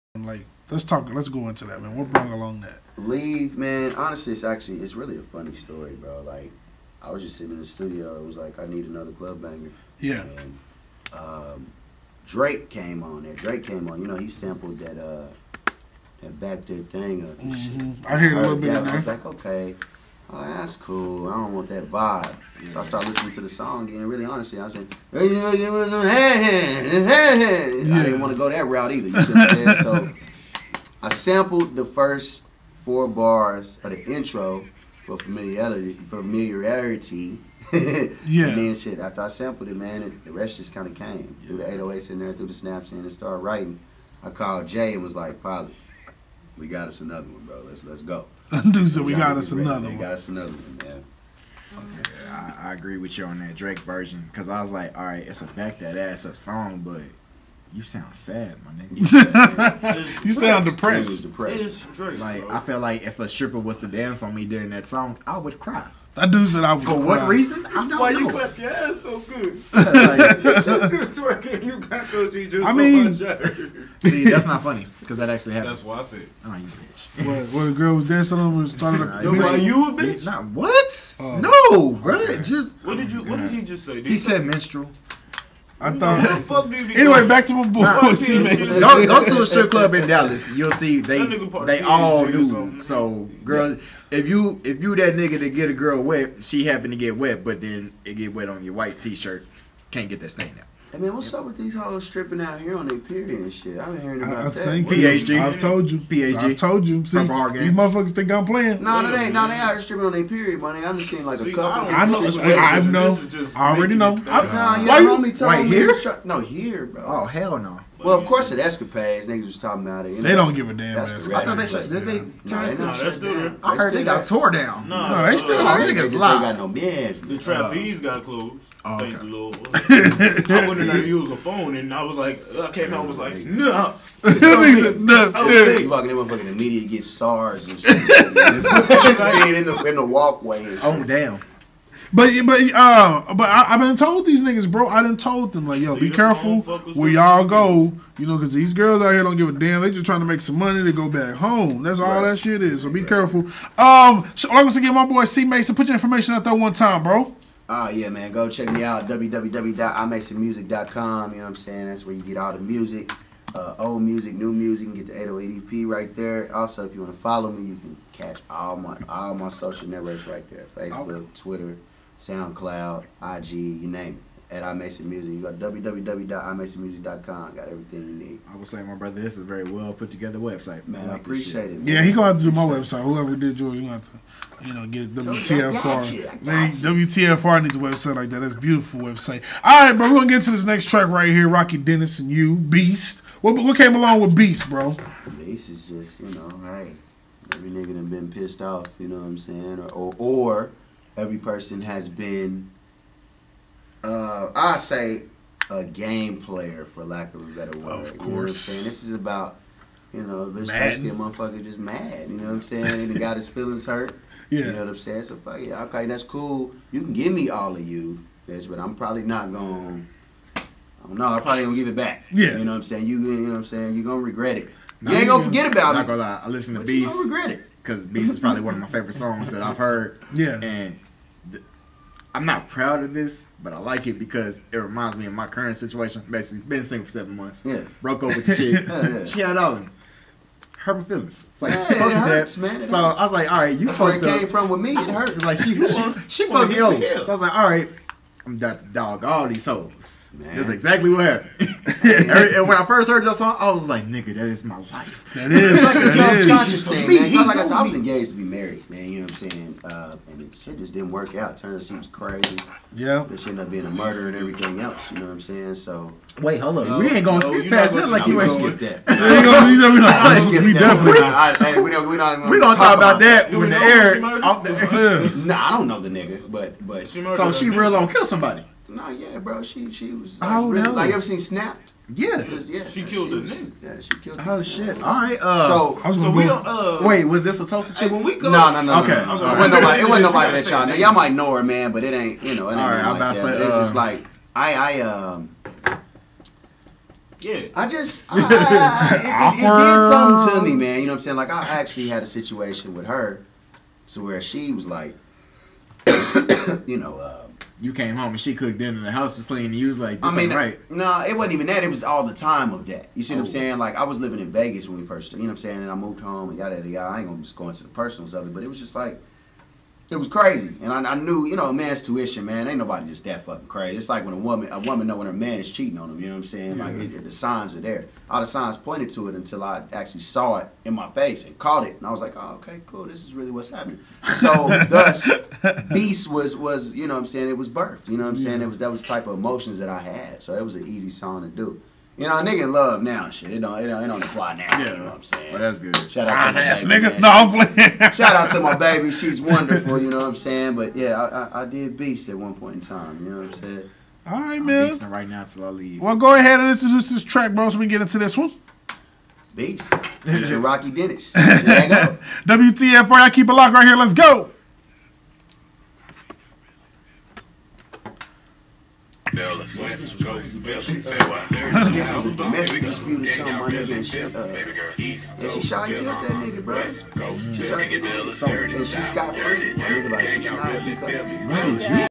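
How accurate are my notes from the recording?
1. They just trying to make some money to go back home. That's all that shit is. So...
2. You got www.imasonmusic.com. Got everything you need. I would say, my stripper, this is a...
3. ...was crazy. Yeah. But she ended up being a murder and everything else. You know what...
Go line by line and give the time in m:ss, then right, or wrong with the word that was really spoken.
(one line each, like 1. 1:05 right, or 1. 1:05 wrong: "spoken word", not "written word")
1. 2:29 right
2. 2:55 wrong: "brother", not "stripper"
3. 4:21 right.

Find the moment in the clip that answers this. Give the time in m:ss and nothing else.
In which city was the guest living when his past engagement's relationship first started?
5:14.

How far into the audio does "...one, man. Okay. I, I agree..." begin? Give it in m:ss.
0:50.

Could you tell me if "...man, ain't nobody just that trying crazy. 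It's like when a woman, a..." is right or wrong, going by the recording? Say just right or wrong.
wrong.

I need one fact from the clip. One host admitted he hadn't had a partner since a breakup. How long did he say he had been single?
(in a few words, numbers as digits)
7 months.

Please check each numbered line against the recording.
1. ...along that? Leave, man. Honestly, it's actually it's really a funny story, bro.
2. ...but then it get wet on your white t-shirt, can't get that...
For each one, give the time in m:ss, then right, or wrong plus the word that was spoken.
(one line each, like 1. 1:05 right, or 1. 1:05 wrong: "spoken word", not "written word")
1. 0:02 right
2. 1:37 right.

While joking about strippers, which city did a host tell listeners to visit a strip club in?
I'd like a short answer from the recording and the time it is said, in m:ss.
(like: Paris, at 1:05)
Dallas, at 1:30.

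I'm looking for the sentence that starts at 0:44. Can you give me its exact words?
I called Jay and was like, "Pilot, we got us another one, bro.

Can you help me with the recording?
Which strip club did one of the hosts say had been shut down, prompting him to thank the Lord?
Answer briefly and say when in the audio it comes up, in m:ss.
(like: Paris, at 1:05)
The Trapeze, at 2:07.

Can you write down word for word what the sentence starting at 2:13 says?
Nah, nah, you walking in, motherfucking, the media gets SARS and shit.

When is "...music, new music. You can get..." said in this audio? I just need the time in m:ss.
2:44.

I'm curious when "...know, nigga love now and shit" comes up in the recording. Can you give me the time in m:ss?
5:42.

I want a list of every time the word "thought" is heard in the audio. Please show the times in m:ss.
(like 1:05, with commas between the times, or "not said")
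1:25, 2:01.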